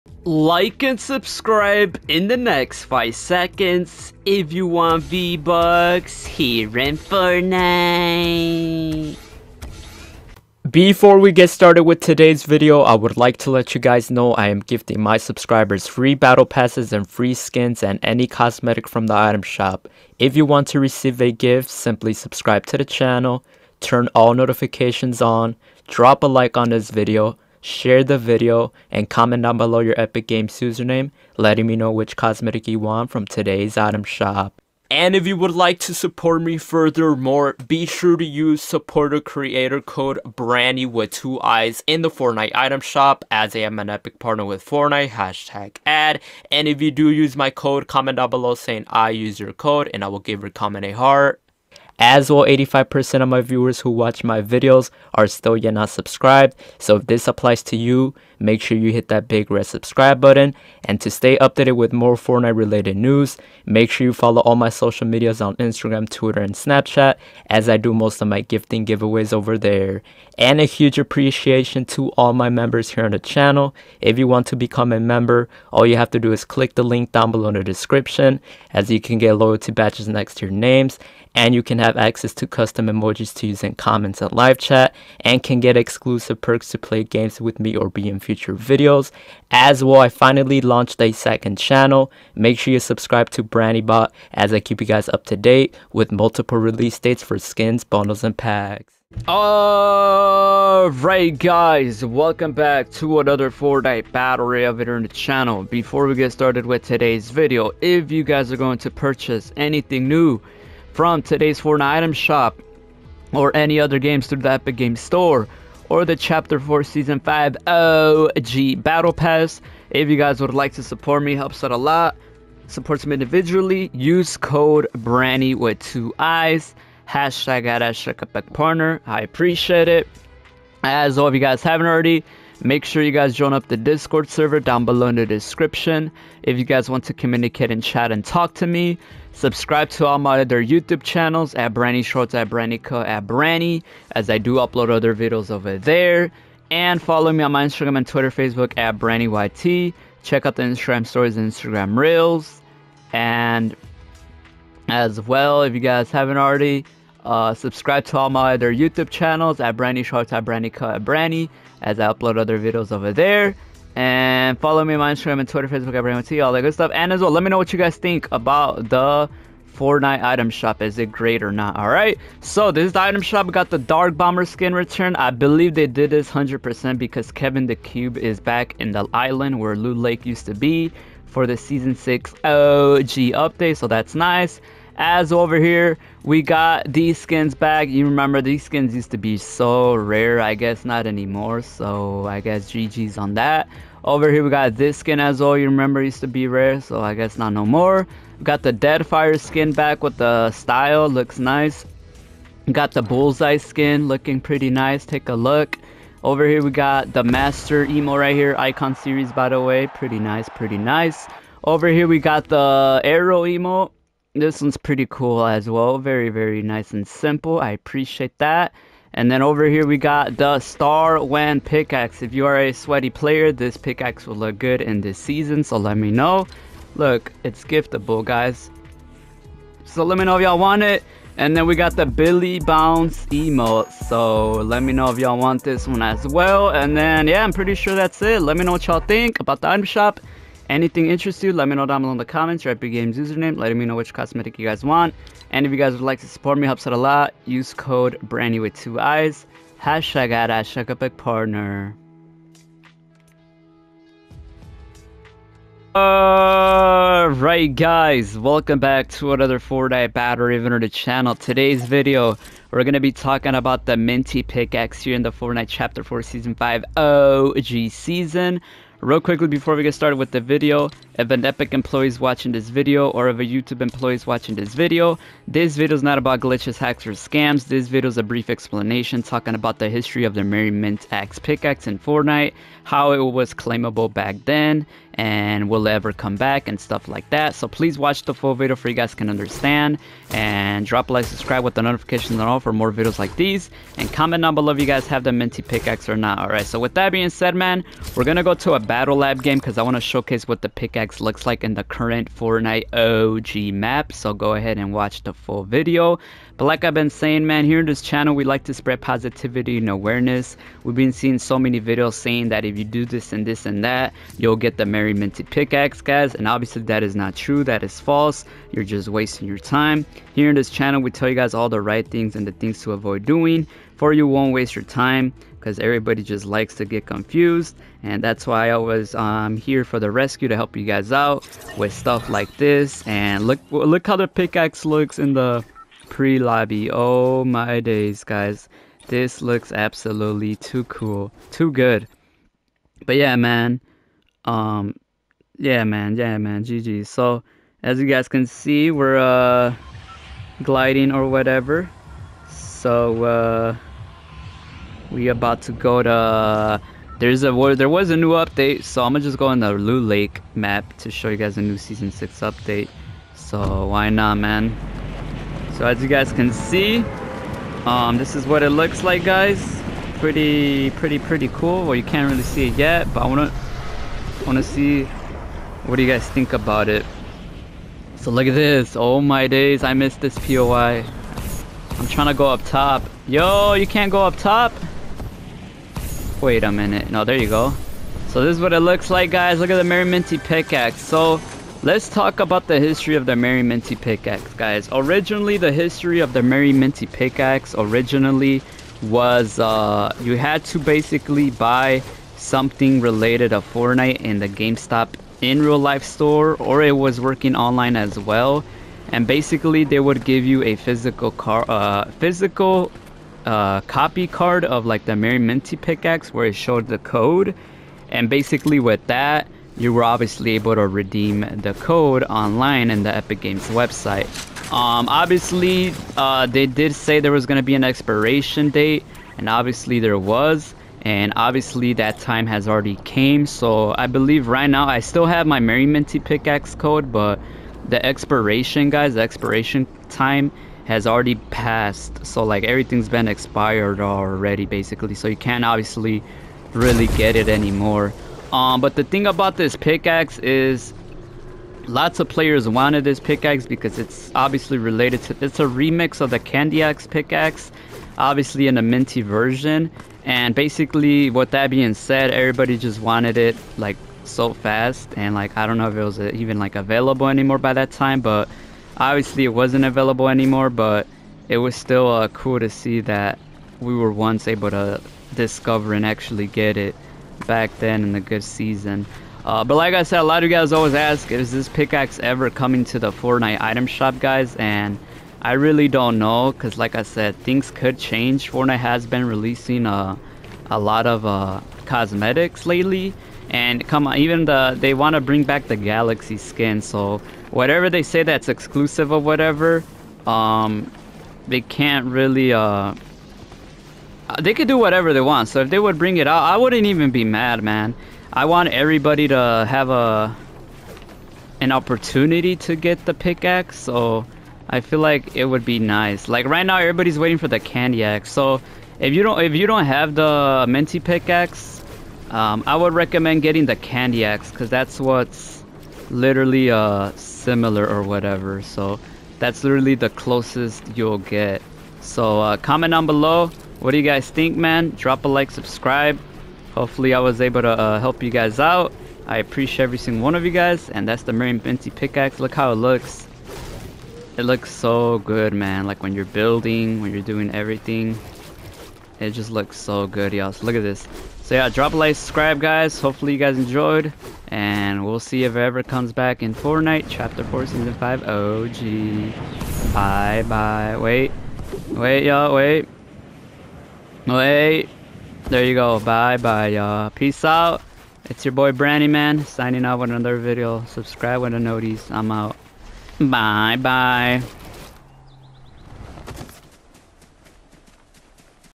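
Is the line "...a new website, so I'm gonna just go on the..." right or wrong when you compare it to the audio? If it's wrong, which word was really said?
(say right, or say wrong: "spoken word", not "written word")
wrong: "update", not "website".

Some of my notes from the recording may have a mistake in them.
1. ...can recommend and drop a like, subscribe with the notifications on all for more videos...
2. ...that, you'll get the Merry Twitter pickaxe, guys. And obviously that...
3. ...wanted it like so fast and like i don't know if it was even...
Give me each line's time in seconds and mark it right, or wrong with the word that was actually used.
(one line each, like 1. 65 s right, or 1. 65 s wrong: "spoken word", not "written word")
1. 289 s wrong: "understand", not "recommend"
2. 313 s wrong: "Minty", not "Twitter"
3. 463 s right.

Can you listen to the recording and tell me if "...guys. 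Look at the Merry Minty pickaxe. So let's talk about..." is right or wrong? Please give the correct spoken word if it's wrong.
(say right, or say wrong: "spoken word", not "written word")
right.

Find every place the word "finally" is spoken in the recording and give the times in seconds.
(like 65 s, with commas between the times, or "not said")
90 s.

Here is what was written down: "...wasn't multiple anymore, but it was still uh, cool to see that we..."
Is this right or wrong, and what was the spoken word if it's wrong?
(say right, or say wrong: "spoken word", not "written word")
wrong: "available", not "multiple".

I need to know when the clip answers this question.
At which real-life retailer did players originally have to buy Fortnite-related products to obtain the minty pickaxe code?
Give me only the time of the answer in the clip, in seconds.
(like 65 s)
404 s.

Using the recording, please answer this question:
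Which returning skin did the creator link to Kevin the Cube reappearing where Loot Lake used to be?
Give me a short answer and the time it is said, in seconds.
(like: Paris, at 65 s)
Dark Bomber, at 173 s.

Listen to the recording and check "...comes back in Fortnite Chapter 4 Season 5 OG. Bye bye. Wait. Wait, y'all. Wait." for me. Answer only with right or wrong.
right.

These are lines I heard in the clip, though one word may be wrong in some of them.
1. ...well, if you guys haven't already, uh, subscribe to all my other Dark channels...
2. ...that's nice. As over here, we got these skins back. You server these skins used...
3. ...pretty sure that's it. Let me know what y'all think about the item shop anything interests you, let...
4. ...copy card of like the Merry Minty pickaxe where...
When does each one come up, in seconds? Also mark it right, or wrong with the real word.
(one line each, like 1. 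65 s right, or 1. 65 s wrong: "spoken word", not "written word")
1. 155 s wrong: "YouTube", not "Dark"
2. 183 s wrong: "remember", not "server"
3. 237 s right
4. 413 s right.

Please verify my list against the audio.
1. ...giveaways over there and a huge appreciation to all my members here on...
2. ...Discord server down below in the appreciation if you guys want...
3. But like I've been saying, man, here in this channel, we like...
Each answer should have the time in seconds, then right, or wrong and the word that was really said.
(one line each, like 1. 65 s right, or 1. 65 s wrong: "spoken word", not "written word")
1. 68 s right
2. 133 s wrong: "description", not "appreciation"
3. 306 s right.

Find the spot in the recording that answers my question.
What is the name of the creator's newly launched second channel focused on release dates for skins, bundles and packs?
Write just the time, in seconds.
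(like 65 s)
93 s.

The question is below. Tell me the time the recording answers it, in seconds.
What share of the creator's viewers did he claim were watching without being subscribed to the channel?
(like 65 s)
52 s.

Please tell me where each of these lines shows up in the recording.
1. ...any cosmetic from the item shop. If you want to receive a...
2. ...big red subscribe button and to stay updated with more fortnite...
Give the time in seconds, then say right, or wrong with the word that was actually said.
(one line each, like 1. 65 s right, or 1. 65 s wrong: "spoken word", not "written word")
1. 18 s right
2. 59 s right.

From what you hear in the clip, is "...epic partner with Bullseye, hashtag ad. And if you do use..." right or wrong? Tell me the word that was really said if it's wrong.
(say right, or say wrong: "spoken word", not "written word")
wrong: "Fortnite", not "Bullseye".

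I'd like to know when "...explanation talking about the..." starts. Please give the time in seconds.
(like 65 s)
278 s.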